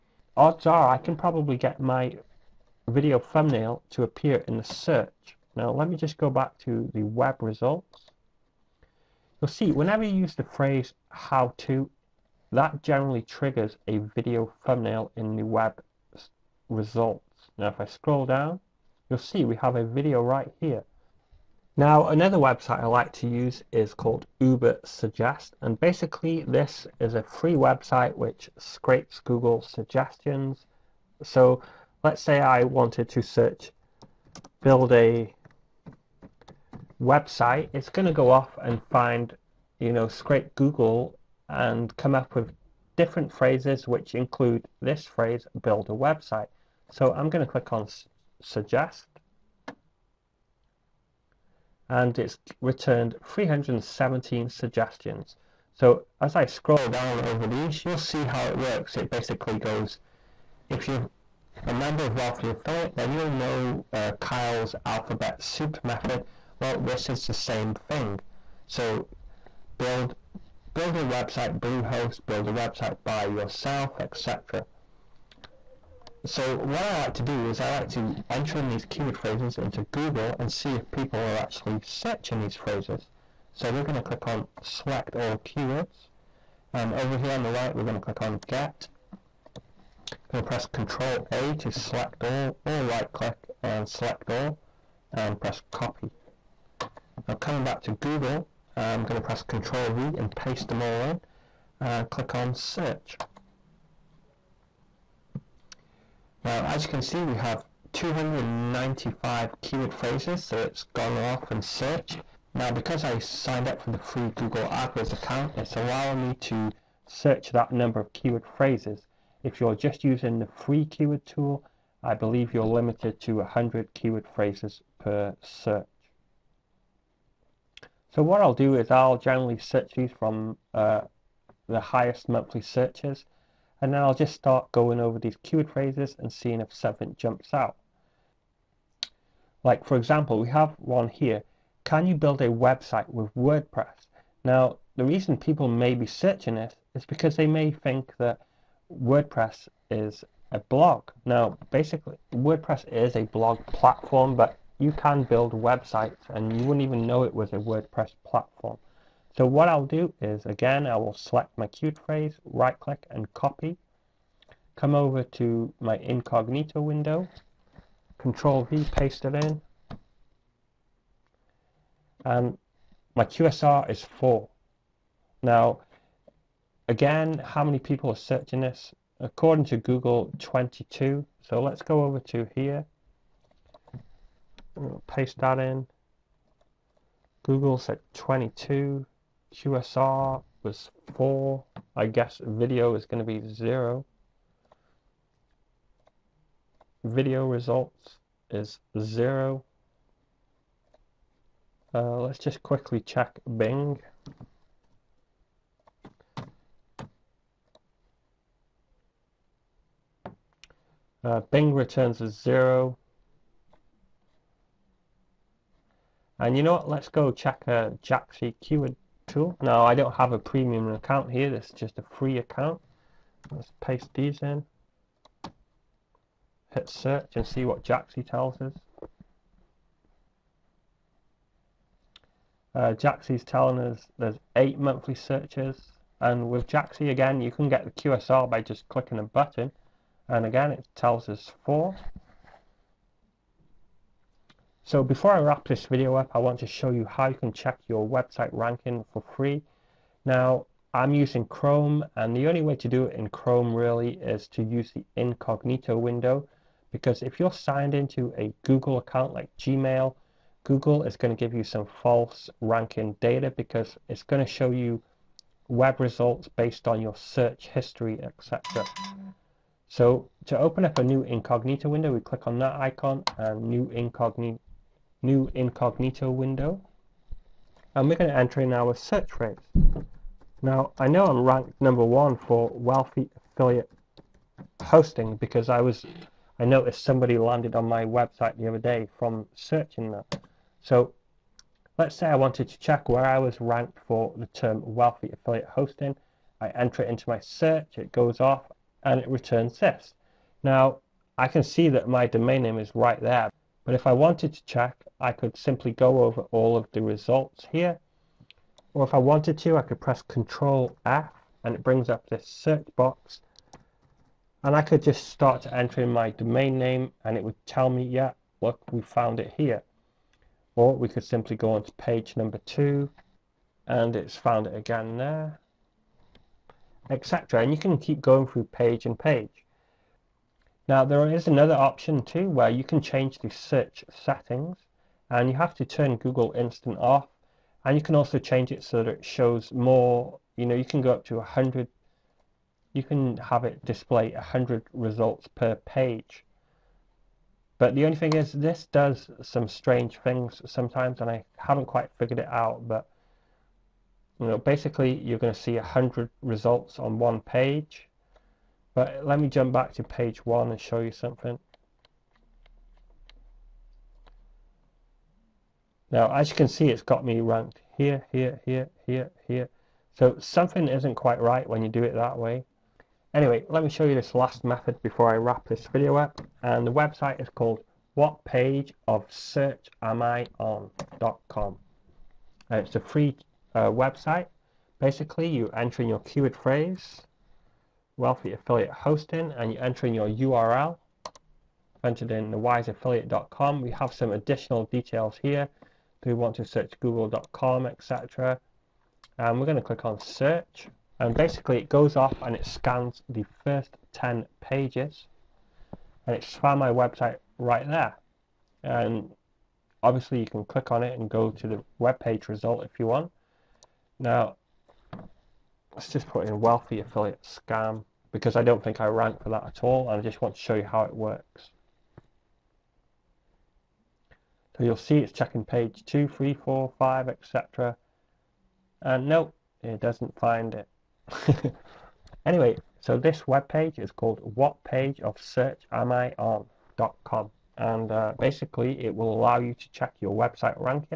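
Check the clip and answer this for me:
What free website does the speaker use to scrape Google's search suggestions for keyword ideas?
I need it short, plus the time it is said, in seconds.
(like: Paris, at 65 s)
Uber Suggest, at 24 s.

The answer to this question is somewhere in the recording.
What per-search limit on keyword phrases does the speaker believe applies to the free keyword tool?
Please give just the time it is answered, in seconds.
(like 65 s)
123 s.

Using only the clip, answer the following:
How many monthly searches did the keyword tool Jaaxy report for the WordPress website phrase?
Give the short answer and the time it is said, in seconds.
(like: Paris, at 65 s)
8, at 234 s.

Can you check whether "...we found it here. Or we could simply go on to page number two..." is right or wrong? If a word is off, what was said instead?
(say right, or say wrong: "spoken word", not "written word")
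right.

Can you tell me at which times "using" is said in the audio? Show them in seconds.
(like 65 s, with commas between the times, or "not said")
120 s, 251 s.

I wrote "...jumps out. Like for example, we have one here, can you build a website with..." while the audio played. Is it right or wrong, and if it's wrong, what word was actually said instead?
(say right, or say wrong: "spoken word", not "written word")
right.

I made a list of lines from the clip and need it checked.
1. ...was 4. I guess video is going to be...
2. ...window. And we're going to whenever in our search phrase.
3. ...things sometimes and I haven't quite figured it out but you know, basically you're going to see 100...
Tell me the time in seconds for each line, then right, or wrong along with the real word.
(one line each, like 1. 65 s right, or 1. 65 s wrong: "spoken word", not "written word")
1. 190 s right
2. 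276 s wrong: "enter", not "whenever"
3. 350 s right.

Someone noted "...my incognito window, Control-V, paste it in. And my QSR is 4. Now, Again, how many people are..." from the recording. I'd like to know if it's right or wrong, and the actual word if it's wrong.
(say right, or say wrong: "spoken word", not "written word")
right.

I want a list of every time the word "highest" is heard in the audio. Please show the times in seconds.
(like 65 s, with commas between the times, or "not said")
131 s.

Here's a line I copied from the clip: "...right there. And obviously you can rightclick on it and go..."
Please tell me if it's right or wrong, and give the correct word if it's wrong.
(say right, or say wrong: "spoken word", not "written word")
wrong: "click", not "rightclick".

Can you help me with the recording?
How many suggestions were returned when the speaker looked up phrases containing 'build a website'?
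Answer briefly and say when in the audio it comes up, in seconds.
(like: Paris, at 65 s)
317, at 53 s.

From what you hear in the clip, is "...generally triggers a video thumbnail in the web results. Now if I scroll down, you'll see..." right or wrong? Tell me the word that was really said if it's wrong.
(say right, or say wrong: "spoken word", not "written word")
right.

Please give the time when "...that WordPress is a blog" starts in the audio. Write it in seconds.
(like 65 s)
148 s.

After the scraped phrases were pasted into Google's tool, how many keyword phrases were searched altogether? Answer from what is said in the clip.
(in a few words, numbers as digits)
295.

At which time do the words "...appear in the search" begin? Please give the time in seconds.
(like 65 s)
4 s.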